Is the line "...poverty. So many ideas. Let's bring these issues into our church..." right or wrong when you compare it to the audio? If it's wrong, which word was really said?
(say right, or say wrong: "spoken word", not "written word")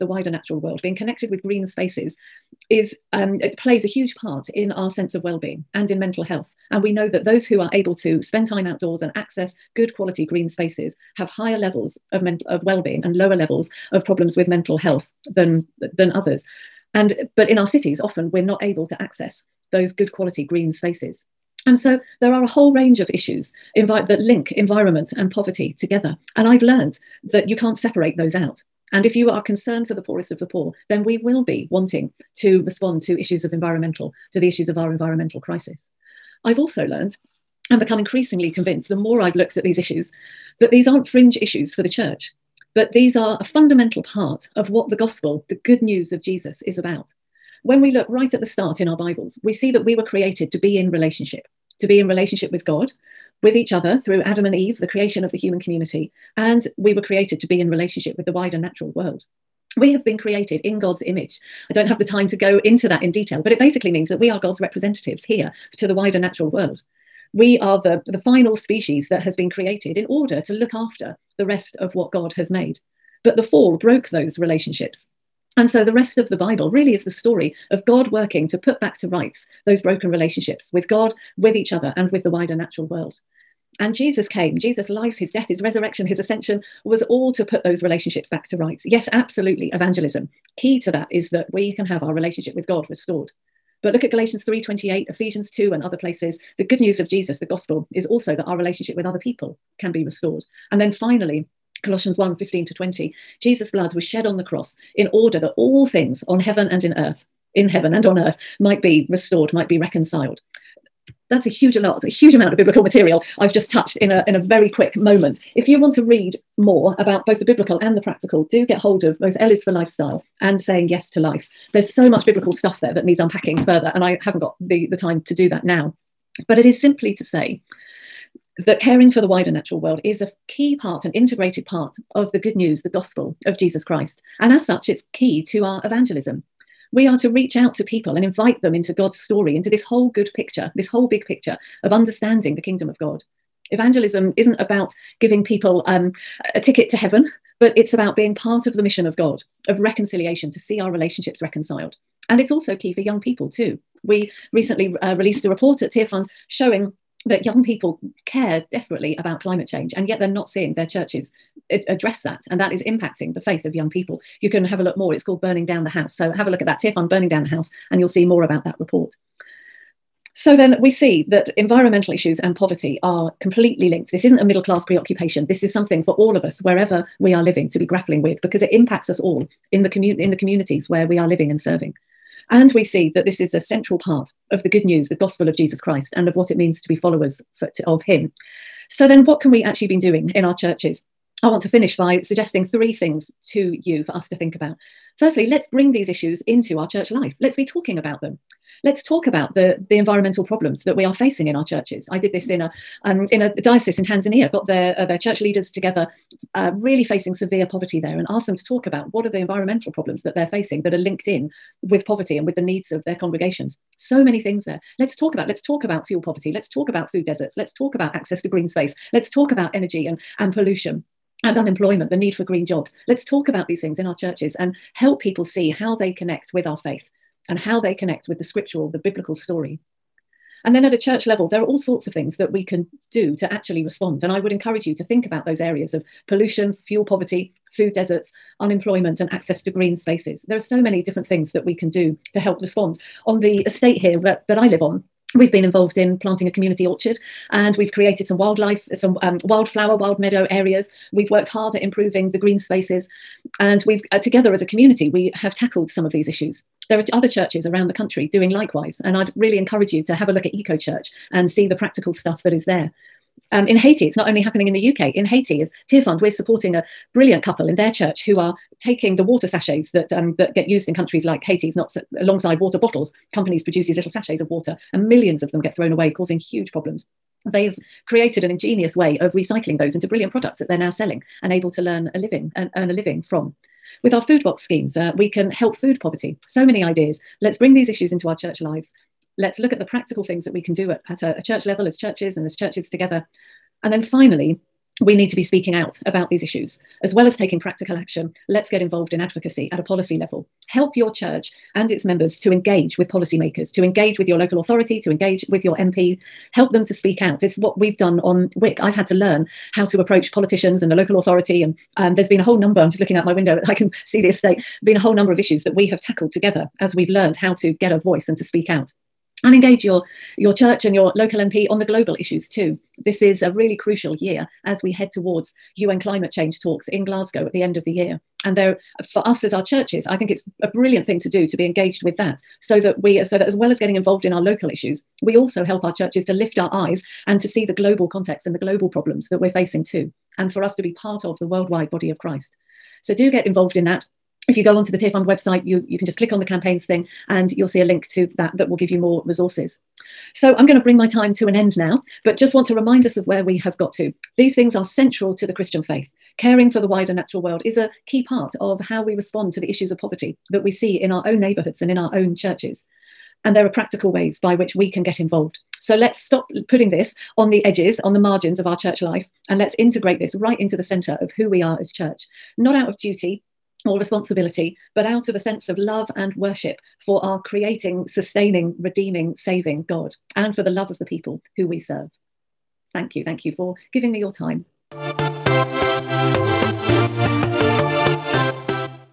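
right.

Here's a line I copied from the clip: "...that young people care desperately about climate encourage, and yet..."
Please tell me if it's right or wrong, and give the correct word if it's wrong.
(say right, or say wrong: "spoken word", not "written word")
wrong: "change", not "encourage".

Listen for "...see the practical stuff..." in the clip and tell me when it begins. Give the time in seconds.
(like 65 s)
261 s.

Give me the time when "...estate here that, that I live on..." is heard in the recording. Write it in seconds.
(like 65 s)
243 s.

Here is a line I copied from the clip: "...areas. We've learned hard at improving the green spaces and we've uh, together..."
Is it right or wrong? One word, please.
wrong.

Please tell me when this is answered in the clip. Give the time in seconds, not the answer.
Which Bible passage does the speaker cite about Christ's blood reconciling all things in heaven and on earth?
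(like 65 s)
101 s.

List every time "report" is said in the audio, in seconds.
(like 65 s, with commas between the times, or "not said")
155 s, 168 s.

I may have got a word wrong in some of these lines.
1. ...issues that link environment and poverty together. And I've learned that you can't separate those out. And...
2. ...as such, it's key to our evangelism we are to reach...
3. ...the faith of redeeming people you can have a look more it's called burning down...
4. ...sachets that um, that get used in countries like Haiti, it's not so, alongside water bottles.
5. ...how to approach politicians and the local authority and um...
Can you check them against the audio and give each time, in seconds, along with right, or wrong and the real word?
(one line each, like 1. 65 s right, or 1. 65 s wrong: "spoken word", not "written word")
1. 23 s right
2. 134 s right
3. 163 s wrong: "young", not "redeeming"
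4. 269 s right
5. 309 s right.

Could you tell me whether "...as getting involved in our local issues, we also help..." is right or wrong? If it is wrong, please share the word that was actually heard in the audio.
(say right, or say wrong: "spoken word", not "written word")
right.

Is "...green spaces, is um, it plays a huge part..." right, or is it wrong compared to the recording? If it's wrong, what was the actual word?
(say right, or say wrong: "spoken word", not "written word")
right.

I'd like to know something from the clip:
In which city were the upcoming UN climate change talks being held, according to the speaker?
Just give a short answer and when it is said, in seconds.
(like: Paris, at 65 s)
Glasgow, at 327 s.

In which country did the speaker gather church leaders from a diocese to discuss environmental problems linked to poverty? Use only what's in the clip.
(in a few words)
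Tanzania.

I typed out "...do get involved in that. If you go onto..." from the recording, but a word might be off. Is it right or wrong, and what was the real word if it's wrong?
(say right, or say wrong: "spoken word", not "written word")
right.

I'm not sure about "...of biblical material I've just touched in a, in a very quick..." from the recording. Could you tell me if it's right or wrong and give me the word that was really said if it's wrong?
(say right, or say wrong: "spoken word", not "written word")
right.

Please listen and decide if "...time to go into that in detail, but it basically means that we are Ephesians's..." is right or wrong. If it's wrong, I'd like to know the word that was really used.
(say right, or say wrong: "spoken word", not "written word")
wrong: "God", not "Ephesians".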